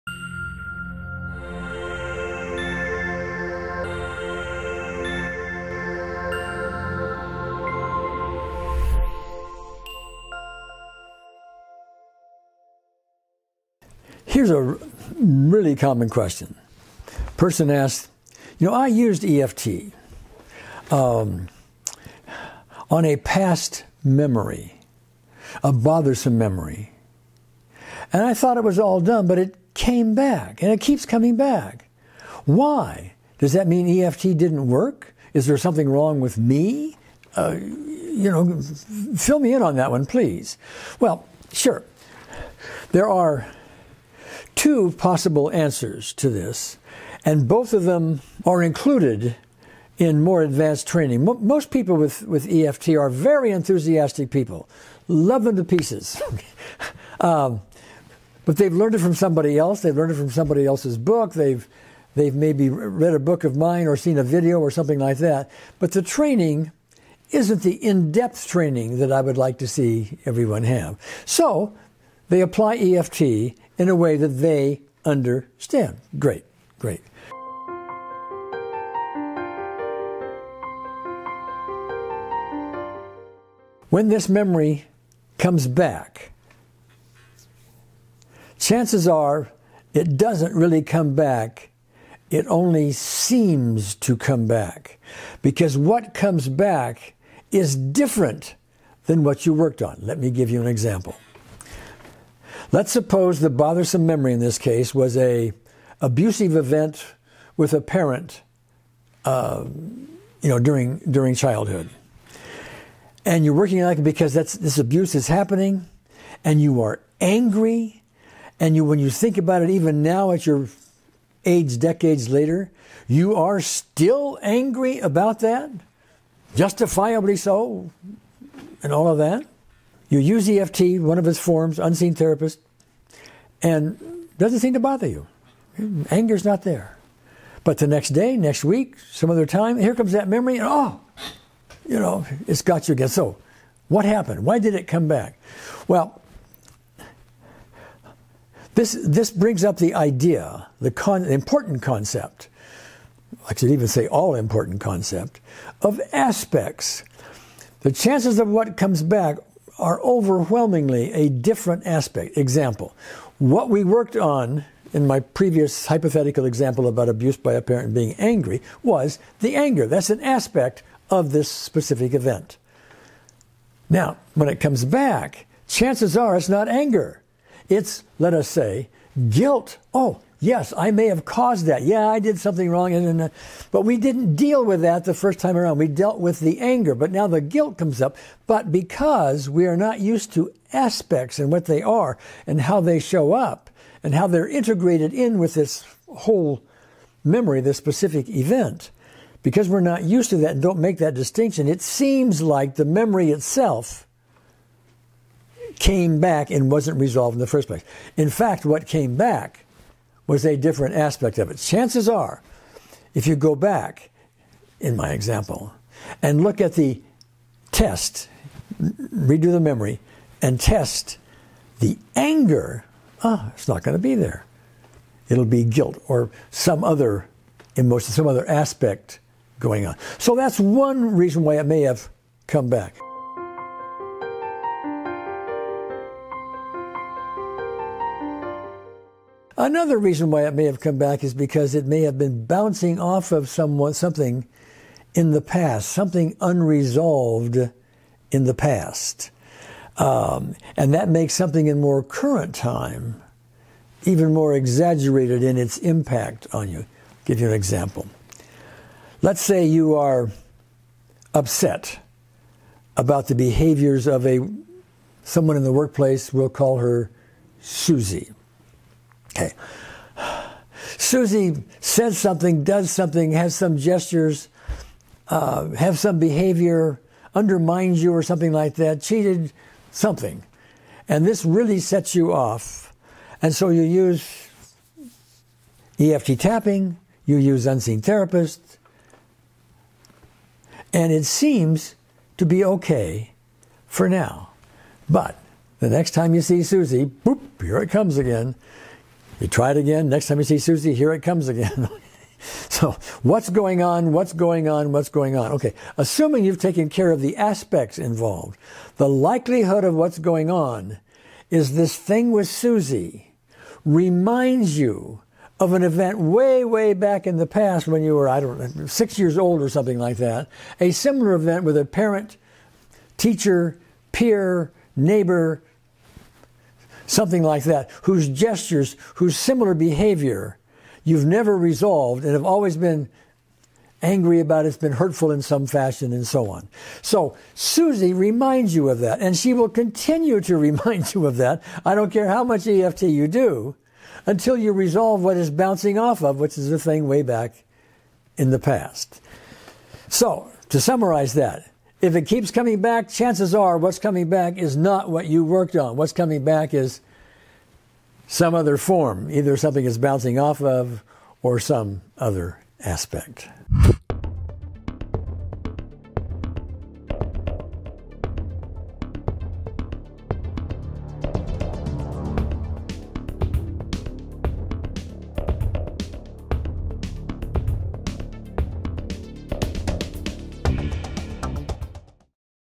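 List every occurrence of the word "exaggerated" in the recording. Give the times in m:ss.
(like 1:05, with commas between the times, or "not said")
4:14.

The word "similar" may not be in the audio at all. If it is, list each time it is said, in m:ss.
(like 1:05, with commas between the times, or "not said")
5:20, 5:29.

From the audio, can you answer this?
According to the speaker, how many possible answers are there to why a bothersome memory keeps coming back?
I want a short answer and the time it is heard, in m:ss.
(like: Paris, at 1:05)
2, at 0:44.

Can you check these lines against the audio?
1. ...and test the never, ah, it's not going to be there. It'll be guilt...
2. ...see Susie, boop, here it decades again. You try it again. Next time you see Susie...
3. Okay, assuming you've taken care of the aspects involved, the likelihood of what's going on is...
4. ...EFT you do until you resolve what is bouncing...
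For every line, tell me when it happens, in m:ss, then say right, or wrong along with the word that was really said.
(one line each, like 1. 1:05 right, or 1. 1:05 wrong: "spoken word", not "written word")
1. 3:40 wrong: "anger", not "never"
2. 4:56 wrong: "comes", not "decades"
3. 5:05 right
4. 5:42 right.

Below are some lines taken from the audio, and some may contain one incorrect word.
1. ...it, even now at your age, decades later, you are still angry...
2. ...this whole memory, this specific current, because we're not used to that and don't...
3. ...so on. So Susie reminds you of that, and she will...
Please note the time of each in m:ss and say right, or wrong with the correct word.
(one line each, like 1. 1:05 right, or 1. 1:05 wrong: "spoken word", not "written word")
1. 1:59 right
2. 3:15 wrong: "event", not "current"
3. 5:36 right.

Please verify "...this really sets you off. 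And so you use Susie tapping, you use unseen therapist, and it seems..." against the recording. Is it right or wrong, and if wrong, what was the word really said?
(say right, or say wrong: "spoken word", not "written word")
wrong: "EFT", not "Susie".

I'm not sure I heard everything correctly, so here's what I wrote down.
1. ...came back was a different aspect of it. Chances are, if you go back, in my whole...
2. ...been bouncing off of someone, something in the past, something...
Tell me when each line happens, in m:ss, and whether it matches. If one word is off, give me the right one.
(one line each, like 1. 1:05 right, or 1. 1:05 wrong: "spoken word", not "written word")
1. 3:28 wrong: "example", not "whole"
2. 4:02 right.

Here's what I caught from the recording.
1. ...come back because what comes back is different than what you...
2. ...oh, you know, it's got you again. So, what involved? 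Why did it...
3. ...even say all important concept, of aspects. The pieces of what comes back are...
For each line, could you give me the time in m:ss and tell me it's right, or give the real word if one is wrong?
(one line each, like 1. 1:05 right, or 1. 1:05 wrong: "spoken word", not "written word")
1. 1:34 right
2. 2:20 wrong: "happened", not "involved"
3. 2:33 wrong: "chances", not "pieces".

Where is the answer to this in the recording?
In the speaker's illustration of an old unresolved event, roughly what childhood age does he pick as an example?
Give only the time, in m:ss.
5:18.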